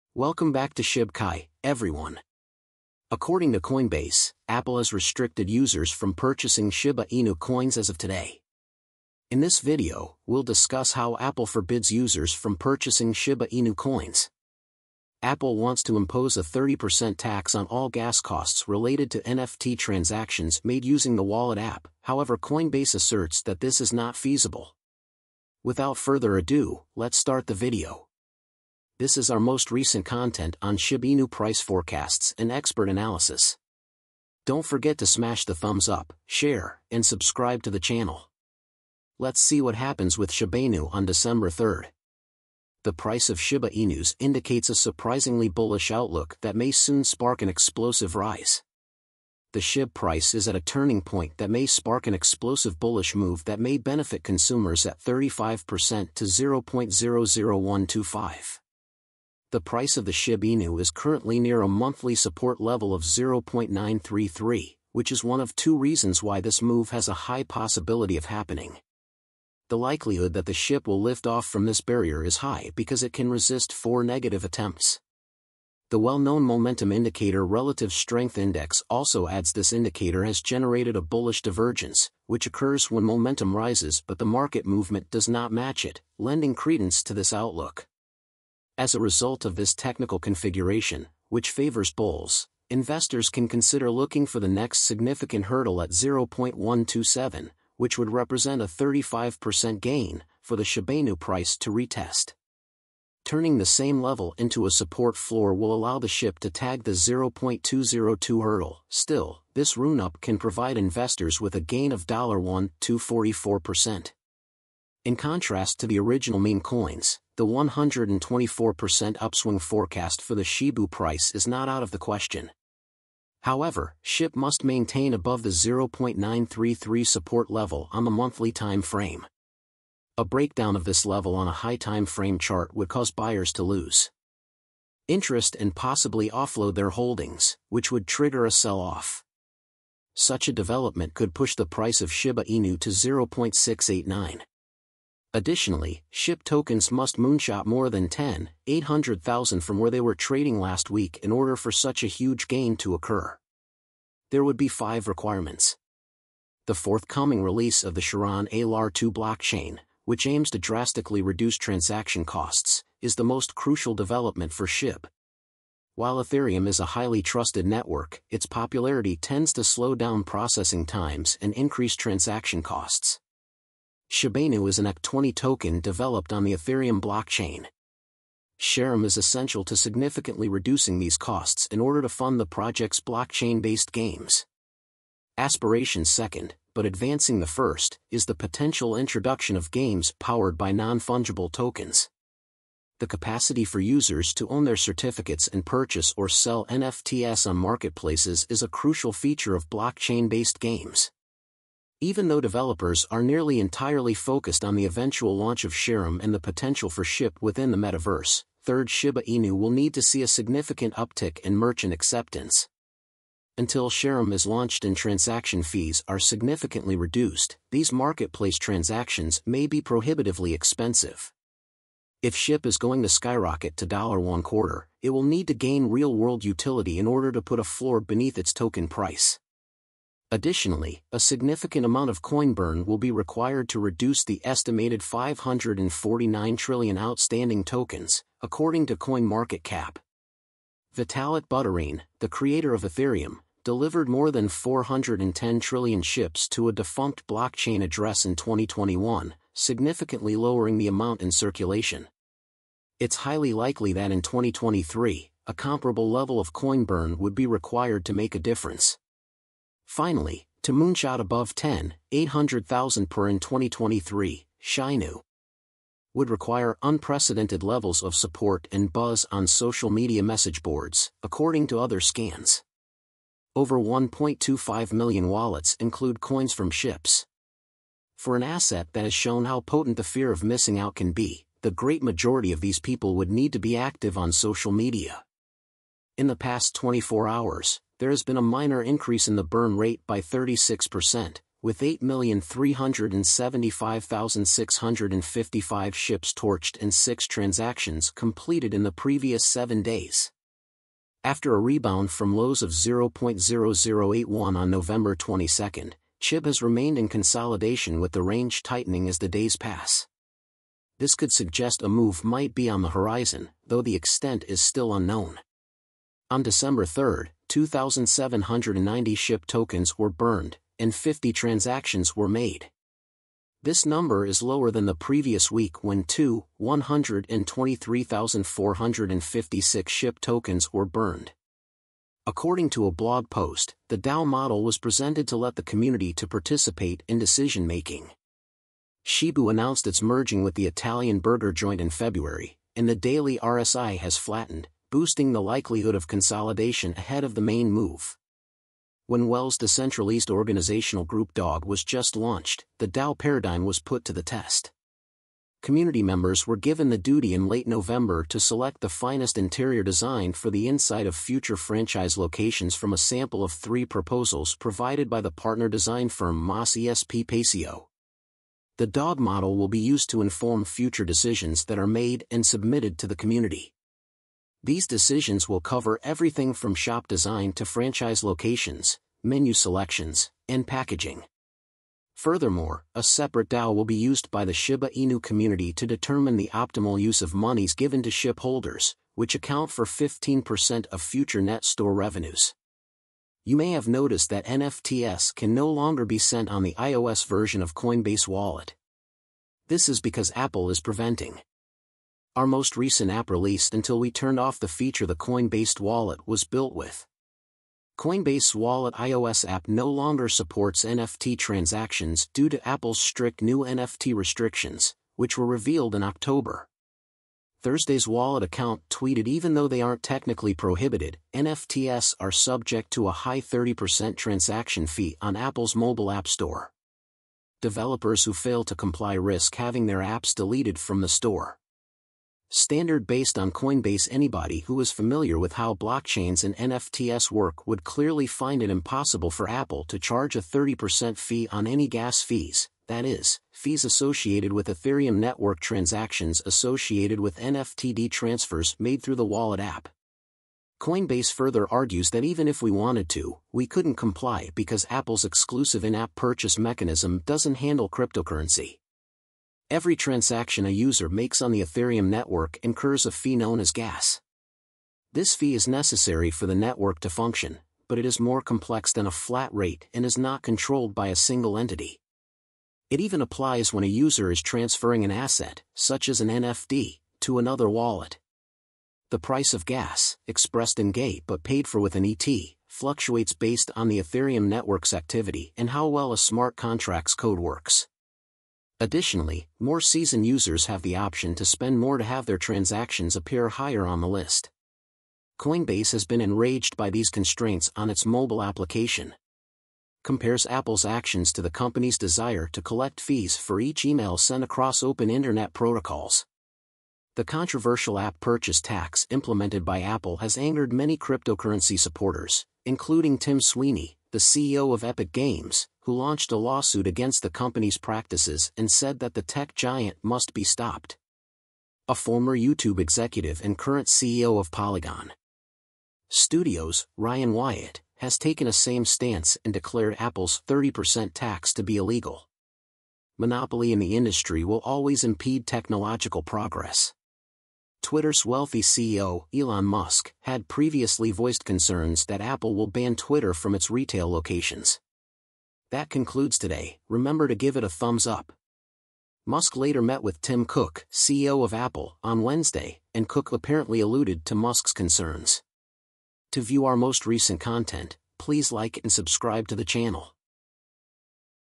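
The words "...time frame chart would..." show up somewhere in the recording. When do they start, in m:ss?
2:11.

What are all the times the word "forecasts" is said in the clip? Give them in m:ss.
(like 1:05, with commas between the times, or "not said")
0:31, 1:59.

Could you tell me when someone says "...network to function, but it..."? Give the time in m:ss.
7:46.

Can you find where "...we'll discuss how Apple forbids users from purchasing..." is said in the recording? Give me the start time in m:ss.
0:10.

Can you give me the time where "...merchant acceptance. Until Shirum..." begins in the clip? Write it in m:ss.
3:31.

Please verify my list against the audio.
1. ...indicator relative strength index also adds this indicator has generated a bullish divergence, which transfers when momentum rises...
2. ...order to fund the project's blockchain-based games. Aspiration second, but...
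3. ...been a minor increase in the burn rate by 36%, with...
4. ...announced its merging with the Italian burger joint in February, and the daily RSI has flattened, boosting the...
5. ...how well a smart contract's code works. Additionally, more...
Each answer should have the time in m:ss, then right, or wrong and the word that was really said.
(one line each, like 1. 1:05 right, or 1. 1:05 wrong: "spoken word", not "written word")
1. 1:16 wrong: "occurs", not "transfers"
2. 3:01 right
3. 4:48 right
4. 5:39 right
5. 8:05 right.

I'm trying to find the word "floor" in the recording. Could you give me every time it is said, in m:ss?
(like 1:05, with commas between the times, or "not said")
1:45, 3:47.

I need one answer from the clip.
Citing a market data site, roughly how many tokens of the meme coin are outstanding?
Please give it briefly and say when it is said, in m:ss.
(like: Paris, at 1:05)
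549 trillion, at 3:55.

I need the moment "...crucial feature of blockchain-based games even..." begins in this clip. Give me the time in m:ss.
3:18.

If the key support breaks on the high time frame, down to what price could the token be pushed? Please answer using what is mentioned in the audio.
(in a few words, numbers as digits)
0.689.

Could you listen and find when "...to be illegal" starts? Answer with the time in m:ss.
8:51.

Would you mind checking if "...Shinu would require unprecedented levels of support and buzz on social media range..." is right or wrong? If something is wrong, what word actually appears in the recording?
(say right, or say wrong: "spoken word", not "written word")
wrong: "message", not "range".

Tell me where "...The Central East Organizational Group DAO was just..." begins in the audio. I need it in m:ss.
5:49.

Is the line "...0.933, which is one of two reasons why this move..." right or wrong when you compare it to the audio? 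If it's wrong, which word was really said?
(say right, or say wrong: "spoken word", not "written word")
right.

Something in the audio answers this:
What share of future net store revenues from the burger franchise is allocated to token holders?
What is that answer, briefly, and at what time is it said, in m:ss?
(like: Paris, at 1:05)
15%, at 6:29.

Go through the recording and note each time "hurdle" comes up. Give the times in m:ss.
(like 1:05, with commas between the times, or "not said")
1:35, 1:48.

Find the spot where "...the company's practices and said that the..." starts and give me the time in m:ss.
8:37.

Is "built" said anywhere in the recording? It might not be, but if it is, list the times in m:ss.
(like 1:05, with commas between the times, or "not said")
6:46.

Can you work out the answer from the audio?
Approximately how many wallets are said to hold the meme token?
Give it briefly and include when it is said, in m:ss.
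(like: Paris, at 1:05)
1.25 million, at 4:33.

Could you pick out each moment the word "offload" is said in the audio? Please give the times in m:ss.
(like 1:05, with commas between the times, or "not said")
2:16.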